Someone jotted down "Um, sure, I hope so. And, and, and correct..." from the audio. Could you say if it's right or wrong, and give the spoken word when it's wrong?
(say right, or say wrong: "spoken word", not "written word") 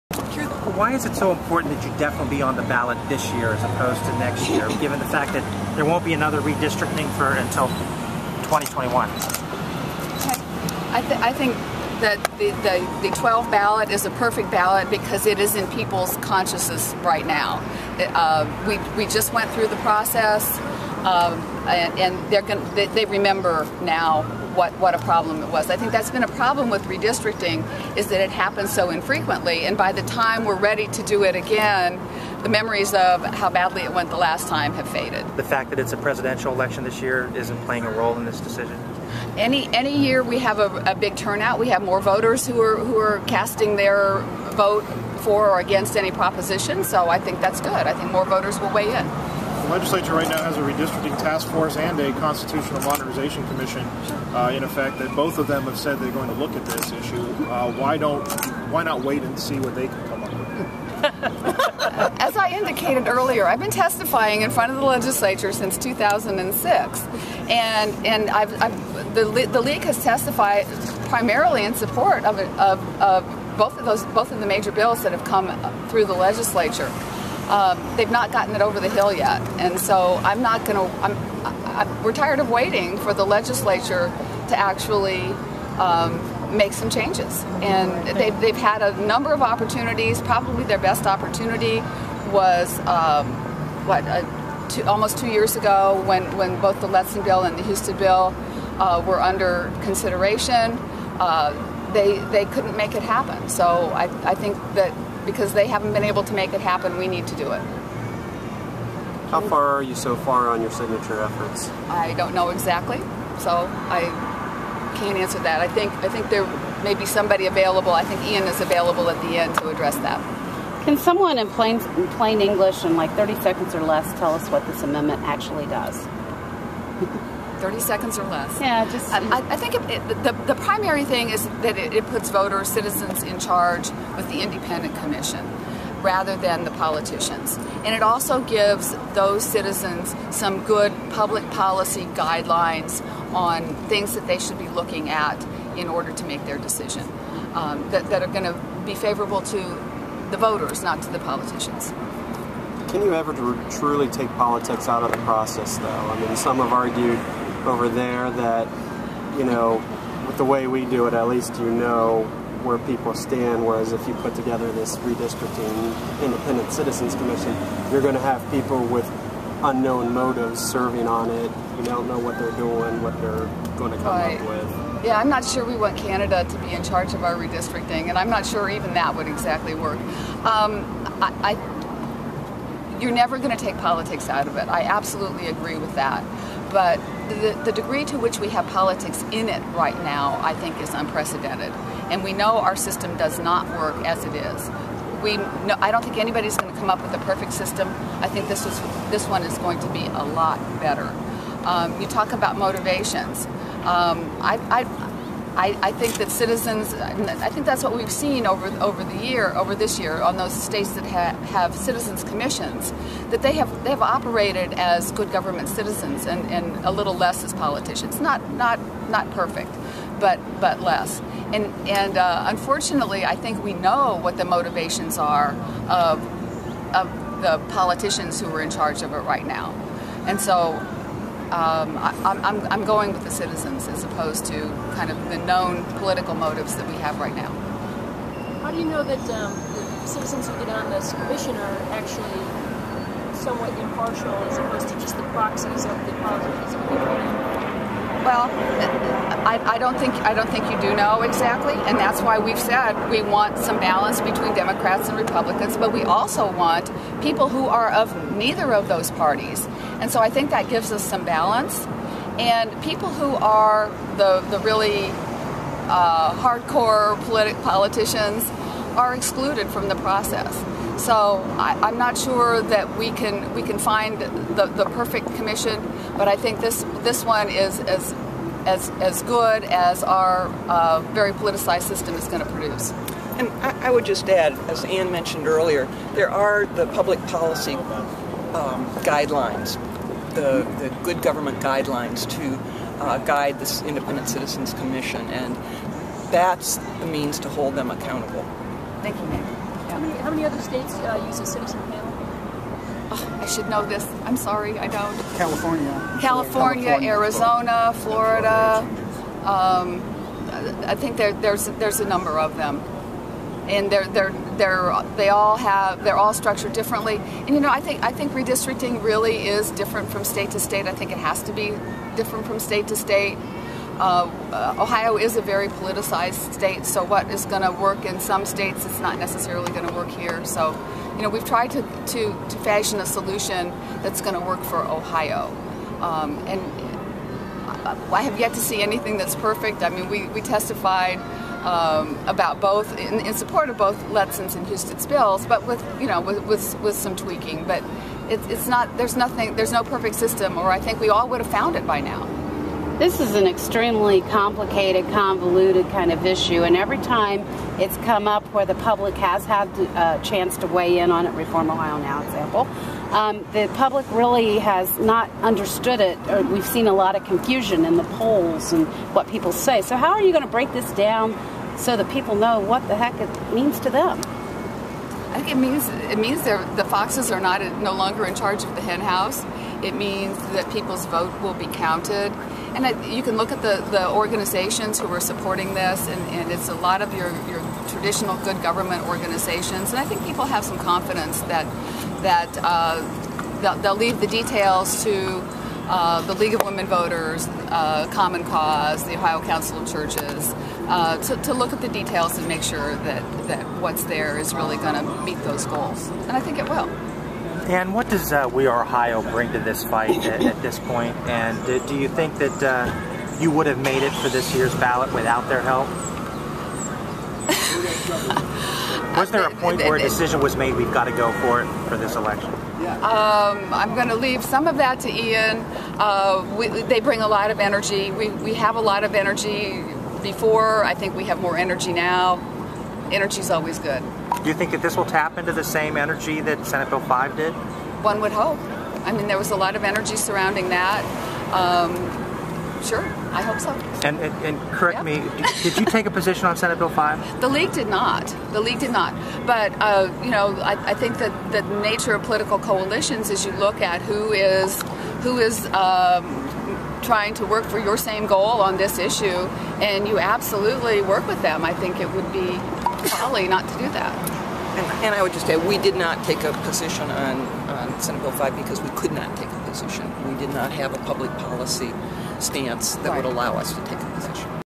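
right.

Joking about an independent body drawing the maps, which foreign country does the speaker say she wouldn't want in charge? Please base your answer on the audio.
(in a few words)
Canada.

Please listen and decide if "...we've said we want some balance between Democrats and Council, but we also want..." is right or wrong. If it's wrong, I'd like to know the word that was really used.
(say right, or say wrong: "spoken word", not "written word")
wrong: "Republicans", not "Council".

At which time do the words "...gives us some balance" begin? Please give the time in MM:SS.
04:20.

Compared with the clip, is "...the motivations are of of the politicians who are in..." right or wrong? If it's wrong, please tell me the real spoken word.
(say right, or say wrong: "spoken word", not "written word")
right.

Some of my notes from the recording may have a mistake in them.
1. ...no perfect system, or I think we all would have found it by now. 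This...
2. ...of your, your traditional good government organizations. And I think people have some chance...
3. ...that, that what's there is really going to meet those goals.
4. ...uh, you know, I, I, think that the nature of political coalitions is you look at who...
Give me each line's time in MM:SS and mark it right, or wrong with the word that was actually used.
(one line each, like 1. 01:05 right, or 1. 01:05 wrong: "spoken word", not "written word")
1. 05:49 right
2. 06:27 wrong: "confidence", not "chance"
3. 06:42 right
4. 07:29 right.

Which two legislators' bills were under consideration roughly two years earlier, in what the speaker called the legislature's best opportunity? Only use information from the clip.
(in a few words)
Letson and Husted.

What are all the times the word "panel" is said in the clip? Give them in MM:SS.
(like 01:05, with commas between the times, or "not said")
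05:01.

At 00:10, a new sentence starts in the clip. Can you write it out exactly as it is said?
I, th I think that the, the, the, 12 ballot is a perfect ballot because it is in people's consciousness right now.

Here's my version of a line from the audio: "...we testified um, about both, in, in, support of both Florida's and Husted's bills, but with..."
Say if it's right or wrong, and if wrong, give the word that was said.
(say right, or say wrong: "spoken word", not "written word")
wrong: "Letson", not "Florida".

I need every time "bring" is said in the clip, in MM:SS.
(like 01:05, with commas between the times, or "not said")
06:49, 07:06.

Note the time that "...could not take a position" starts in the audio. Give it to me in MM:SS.
07:48.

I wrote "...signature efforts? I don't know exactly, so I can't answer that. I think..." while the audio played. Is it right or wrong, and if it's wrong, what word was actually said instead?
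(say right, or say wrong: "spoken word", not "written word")
right.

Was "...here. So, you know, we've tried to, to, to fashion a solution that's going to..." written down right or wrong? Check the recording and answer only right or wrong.
right.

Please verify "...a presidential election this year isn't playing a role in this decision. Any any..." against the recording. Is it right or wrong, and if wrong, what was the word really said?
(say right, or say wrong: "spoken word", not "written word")
right.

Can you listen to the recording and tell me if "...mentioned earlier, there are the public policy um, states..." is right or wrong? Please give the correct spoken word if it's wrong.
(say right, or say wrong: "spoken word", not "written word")
wrong: "guidelines", not "states".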